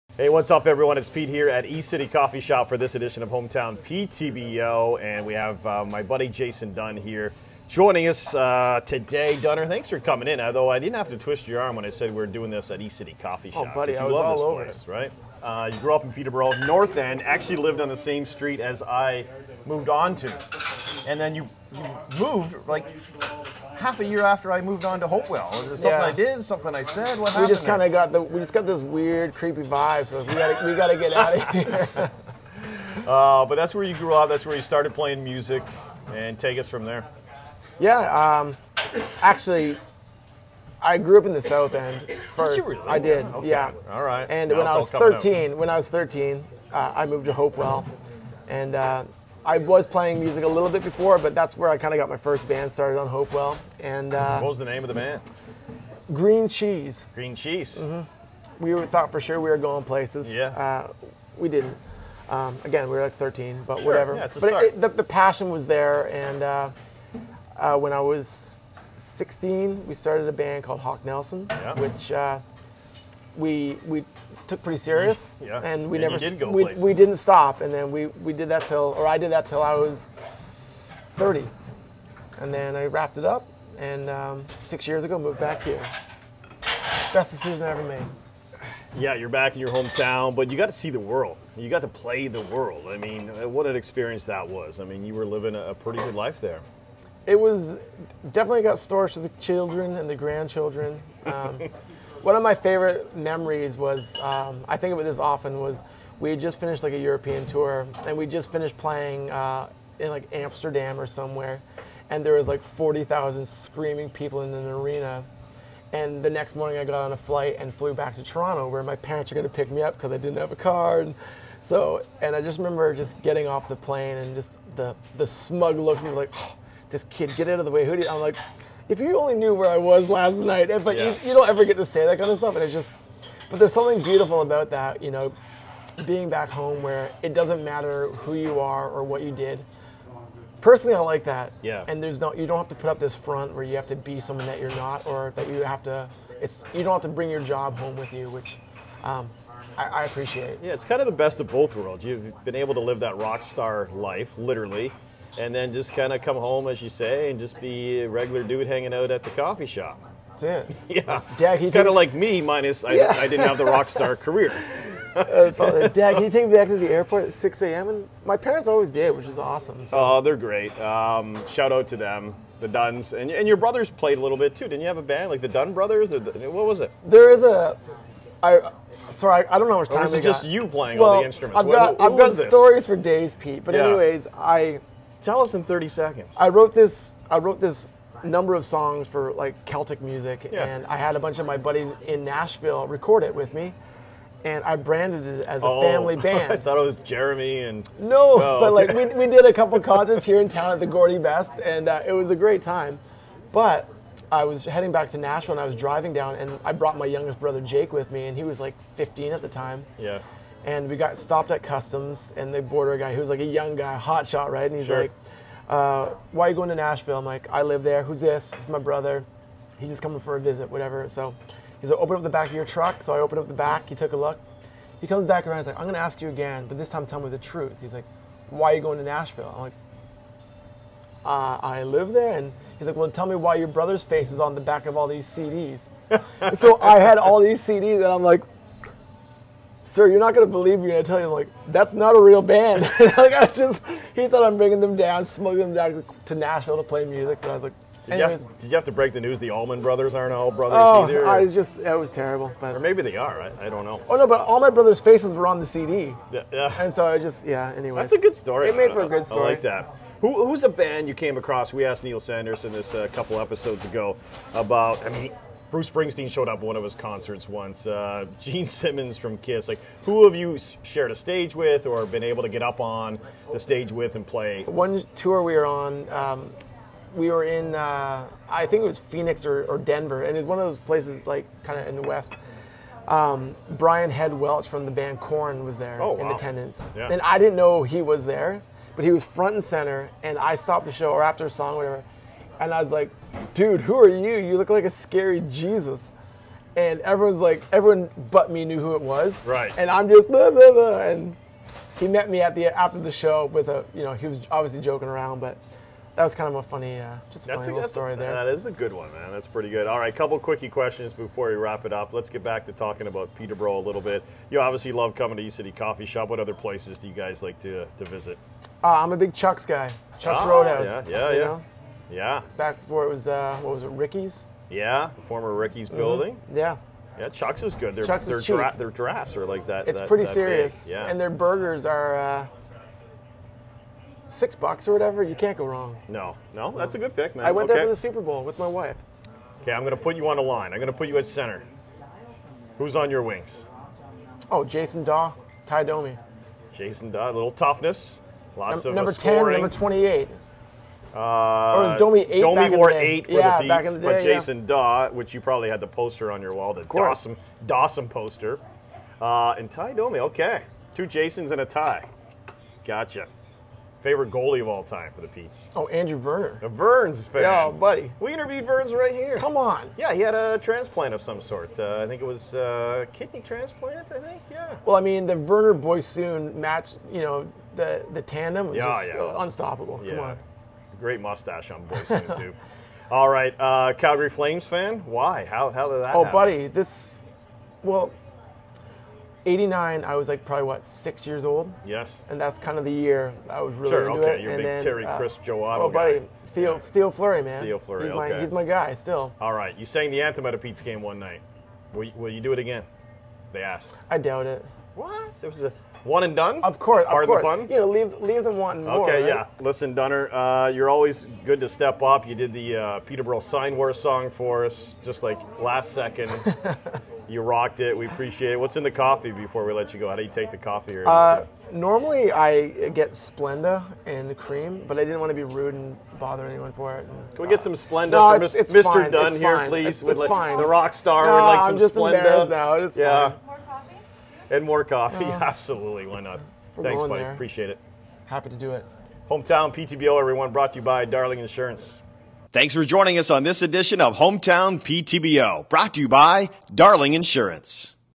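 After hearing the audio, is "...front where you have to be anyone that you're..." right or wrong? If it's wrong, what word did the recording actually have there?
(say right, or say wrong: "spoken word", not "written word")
wrong: "someone", not "anyone".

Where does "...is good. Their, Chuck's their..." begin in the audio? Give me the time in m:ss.
5:27.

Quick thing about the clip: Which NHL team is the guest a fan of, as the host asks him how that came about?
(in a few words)
Calgary Flames.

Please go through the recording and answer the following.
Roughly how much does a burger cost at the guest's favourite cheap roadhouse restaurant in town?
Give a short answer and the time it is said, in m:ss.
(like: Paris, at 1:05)
6 bucks, at 5:34.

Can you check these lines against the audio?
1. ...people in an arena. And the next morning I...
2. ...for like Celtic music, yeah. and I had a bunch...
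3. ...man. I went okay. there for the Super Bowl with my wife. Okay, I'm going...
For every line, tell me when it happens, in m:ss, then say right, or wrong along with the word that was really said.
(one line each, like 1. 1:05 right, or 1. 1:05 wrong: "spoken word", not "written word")
1. 1:54 right
2. 3:09 right
3. 5:37 right.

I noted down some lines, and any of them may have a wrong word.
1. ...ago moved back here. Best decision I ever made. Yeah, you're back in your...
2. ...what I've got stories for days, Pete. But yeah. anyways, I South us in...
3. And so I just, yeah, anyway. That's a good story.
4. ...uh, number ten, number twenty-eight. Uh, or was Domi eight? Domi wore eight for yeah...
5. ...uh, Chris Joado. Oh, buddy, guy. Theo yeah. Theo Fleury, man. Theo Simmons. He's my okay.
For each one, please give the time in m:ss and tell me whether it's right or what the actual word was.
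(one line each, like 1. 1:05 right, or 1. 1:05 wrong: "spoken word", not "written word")
1. 1:25 right
2. 3:02 wrong: "Tell", not "South"
3. 4:16 right
4. 5:48 right
5. 6:35 wrong: "Fleury", not "Simmons".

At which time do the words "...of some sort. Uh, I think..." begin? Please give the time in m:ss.
6:11.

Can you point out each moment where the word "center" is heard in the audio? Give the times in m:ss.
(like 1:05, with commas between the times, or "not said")
4:49, 5:41.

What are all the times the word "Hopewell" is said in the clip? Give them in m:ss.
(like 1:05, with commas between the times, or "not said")
0:25, 0:47, 0:53.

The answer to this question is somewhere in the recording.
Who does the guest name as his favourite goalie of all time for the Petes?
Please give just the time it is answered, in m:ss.
6:05.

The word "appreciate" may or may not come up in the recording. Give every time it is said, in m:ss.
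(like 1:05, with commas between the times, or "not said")
2:30, 6:58, 7:17.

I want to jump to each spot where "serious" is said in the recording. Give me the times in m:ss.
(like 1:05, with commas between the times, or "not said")
1:14, 5:30.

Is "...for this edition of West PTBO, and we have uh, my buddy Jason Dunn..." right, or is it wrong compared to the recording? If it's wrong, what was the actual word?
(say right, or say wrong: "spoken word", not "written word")
wrong: "Hometown", not "West".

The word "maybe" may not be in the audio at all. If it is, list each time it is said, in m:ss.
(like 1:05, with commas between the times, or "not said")
4:12.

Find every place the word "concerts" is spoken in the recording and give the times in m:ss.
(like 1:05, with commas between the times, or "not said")
3:19, 4:26.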